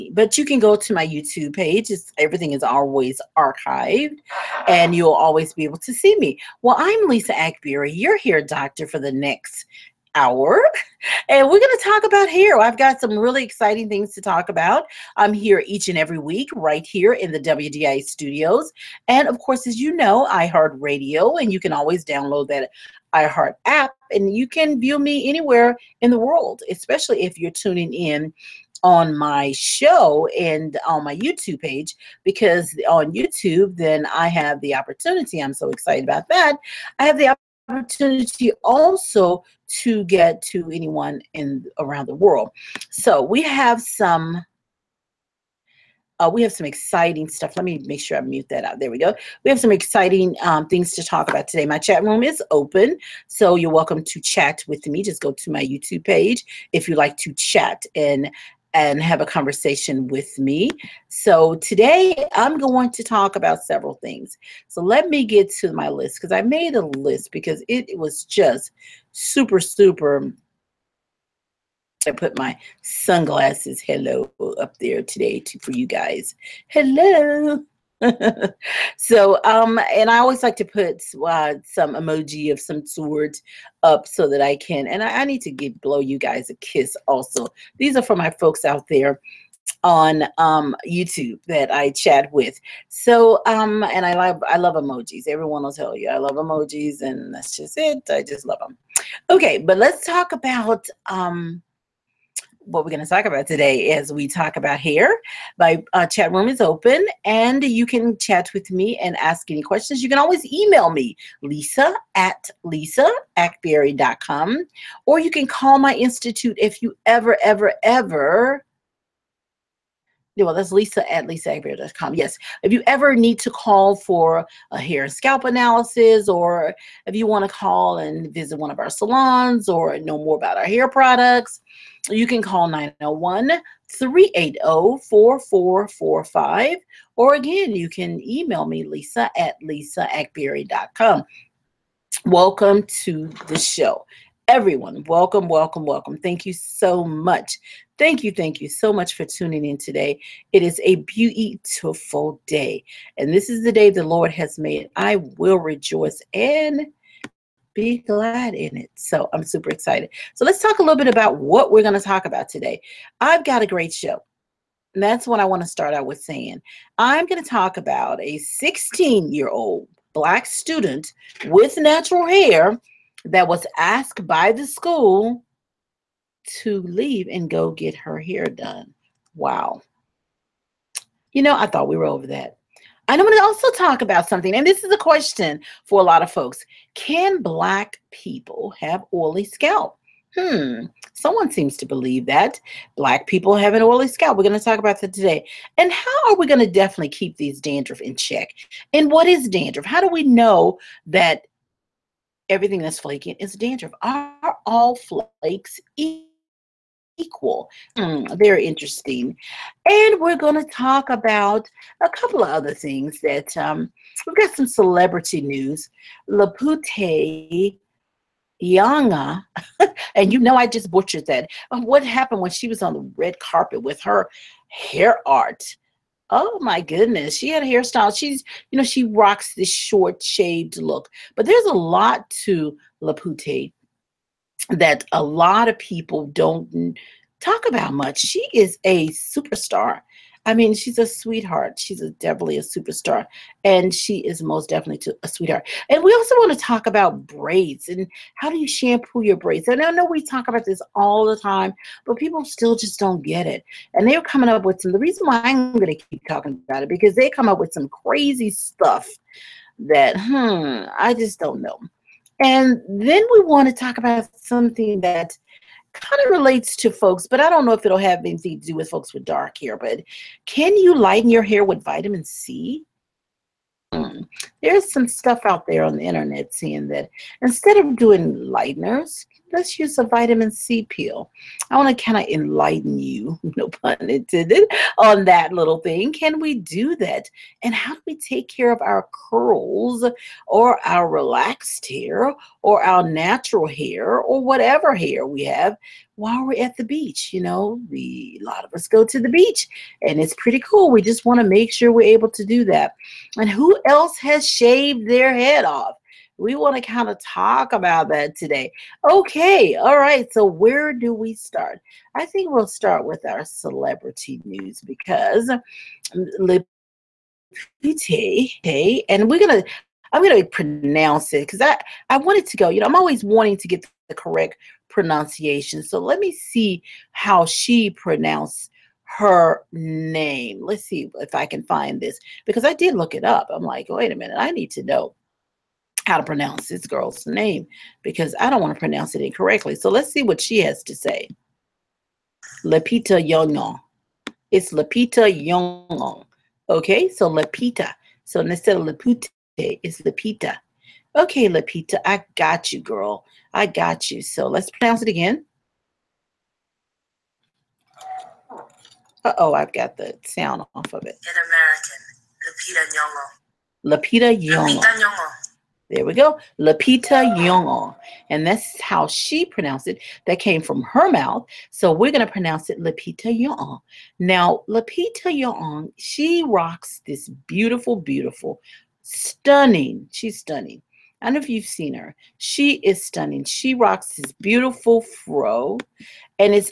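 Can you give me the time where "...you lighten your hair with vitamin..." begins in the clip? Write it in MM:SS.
04:30.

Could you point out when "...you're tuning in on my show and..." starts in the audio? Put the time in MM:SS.
00:27.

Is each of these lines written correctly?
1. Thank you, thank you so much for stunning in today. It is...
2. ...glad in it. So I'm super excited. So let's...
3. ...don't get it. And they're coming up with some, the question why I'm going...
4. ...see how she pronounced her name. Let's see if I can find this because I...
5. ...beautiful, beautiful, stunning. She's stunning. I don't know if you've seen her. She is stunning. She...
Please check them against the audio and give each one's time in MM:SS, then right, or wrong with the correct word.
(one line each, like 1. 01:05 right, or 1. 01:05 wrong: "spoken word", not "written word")
1. 02:27 wrong: "tuning", not "stunning"
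2. 02:37 right
3. 04:12 wrong: "reason", not "question"
4. 05:26 right
5. 06:17 right.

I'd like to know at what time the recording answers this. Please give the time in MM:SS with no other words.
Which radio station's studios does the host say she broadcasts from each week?
00:17.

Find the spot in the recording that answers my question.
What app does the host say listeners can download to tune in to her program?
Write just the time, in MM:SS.
00:23.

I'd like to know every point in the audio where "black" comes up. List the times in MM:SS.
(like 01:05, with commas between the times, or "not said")
02:50, 03:07, 03:12.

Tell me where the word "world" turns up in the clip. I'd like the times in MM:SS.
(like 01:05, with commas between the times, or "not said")
00:26, 00:42.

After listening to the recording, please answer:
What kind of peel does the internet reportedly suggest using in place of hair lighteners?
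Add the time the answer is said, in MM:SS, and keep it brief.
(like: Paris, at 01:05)
Vitamin C peel, at 04:40.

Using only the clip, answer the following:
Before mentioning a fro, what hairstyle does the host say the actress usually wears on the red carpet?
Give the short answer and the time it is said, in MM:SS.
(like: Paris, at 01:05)
Short shaved look, at 03:49.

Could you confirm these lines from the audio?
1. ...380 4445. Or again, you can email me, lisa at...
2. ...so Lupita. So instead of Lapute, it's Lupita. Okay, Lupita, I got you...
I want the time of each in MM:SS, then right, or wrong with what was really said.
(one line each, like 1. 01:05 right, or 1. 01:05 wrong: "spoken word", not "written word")
1. 02:13 right
2. 05:47 right.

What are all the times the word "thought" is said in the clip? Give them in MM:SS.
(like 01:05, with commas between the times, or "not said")
03:01.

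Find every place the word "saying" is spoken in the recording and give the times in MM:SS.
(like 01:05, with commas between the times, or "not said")
02:46, 04:36.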